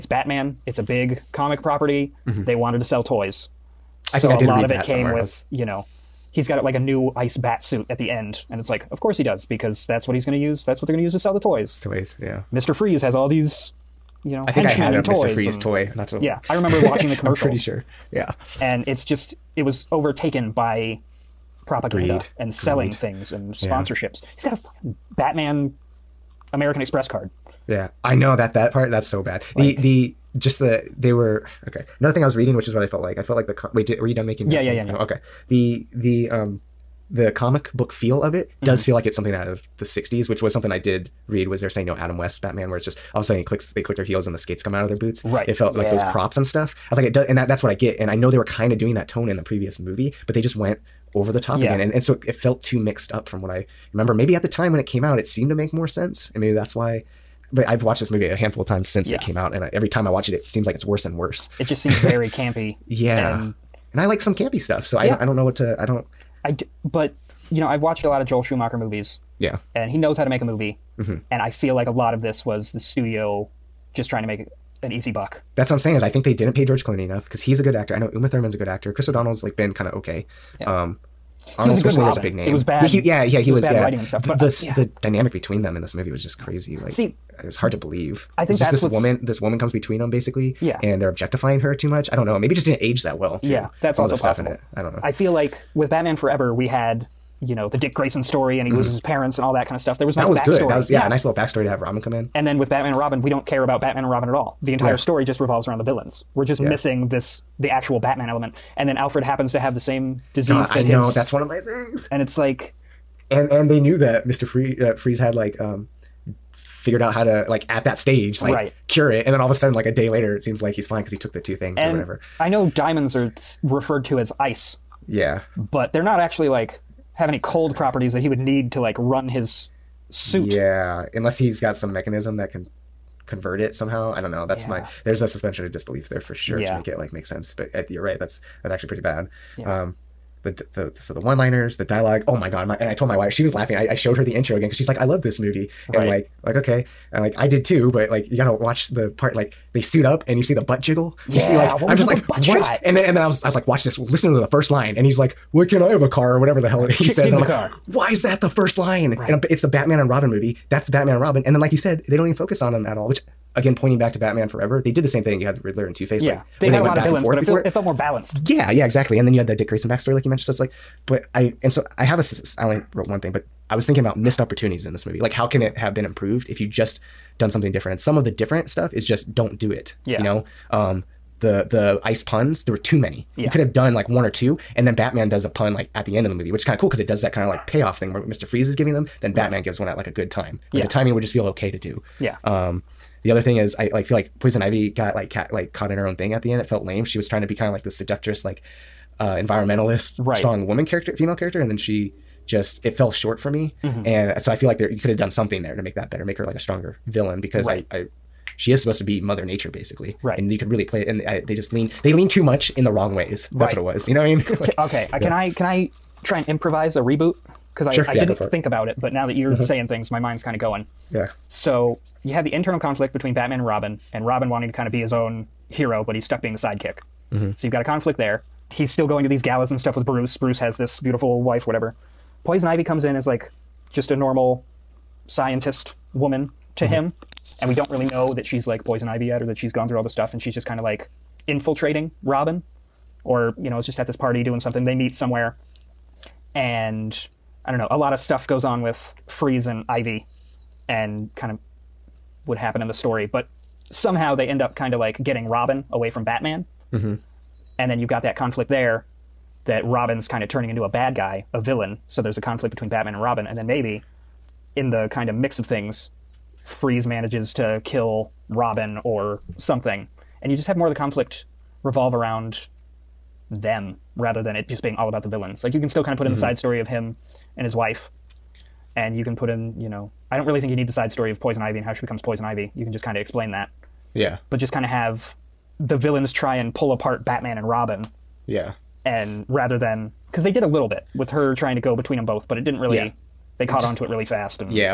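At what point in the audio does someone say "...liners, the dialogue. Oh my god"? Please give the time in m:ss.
2:21.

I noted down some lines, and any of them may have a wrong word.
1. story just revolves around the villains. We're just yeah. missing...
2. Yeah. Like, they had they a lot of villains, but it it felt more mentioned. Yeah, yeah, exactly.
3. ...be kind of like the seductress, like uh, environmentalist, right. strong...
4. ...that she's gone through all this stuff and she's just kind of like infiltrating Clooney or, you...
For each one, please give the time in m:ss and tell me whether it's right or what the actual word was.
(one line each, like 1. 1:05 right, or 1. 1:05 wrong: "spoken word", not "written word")
1. 1:44 right
2. 2:46 wrong: "balanced", not "mentioned"
3. 3:17 right
4. 3:59 wrong: "Robin", not "Clooney".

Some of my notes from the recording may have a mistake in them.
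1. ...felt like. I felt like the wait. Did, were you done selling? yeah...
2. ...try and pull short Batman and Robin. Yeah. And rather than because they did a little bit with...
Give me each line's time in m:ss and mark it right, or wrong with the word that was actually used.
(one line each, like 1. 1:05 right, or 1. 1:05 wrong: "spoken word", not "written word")
1. 0:32 wrong: "making", not "selling"
2. 4:46 wrong: "apart", not "short".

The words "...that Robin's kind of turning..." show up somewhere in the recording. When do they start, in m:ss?
4:19.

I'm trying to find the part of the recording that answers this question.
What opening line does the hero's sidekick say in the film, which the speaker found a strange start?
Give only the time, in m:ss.
2:35.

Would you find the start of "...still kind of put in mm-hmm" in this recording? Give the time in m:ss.
4:35.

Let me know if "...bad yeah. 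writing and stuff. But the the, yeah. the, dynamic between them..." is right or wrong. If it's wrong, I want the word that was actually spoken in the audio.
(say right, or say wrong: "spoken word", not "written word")
right.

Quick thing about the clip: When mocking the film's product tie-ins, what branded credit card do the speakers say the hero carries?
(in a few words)
Batman American Express card.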